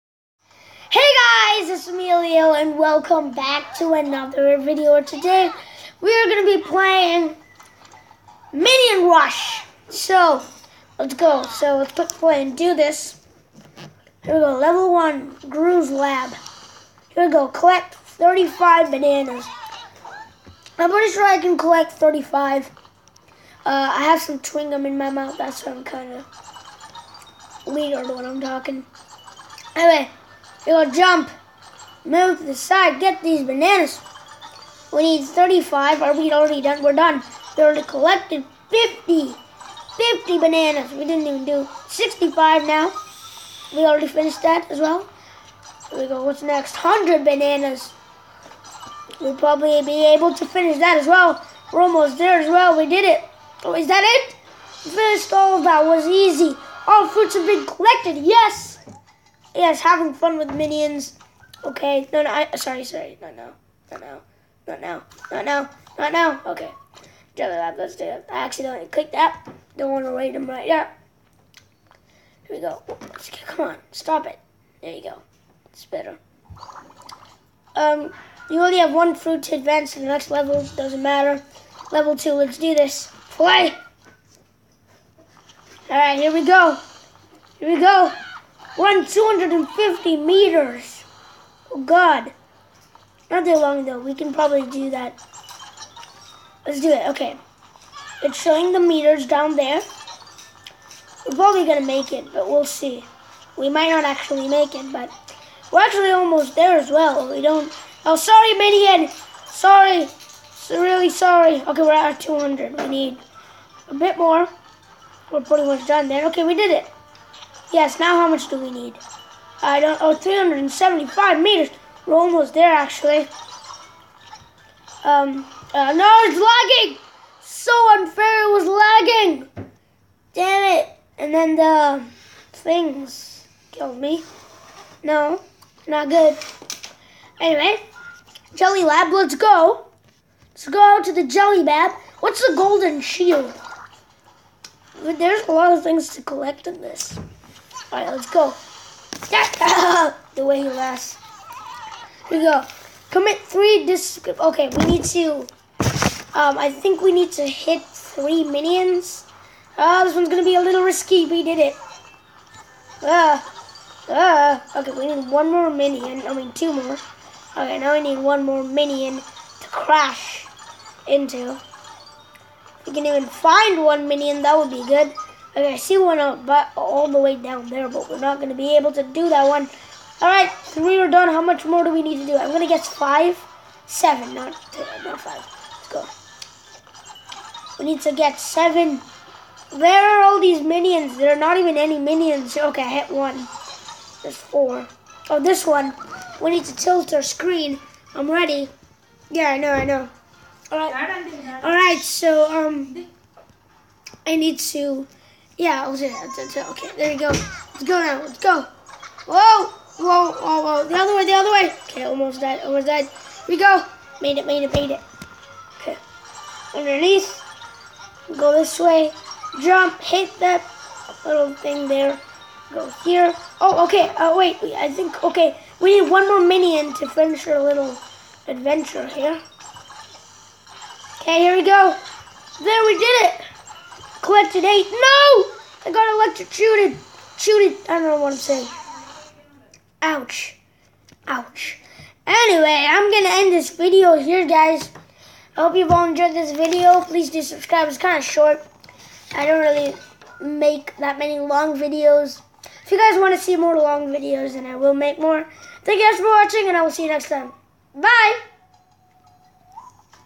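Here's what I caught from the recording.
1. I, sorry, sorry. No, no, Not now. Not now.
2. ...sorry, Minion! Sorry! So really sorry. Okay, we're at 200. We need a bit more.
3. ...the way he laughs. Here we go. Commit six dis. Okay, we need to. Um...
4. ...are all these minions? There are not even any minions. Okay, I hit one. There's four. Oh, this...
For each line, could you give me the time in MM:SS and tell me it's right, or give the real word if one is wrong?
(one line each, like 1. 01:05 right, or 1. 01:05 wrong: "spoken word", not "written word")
1. 01:02 right
2. 01:48 right
3. 02:29 wrong: "three", not "six"
4. 03:10 right.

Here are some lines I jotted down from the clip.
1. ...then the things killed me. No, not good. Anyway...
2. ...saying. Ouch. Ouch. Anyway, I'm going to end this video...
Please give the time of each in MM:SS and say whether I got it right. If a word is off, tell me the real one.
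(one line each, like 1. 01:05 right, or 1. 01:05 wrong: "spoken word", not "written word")
1. 02:11 right
2. 03:58 right.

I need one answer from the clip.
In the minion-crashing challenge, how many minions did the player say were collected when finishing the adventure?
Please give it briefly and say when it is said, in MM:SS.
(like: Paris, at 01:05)
8, at 03:54.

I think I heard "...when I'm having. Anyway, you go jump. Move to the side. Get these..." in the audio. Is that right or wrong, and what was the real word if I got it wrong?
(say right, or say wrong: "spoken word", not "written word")
wrong: "talking", not "having".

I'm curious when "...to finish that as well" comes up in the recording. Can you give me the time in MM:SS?
00:50.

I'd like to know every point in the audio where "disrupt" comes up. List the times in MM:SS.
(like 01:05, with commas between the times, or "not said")
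not said.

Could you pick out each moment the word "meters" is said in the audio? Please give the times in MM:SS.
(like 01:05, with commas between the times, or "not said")
01:30, 01:38, 02:01.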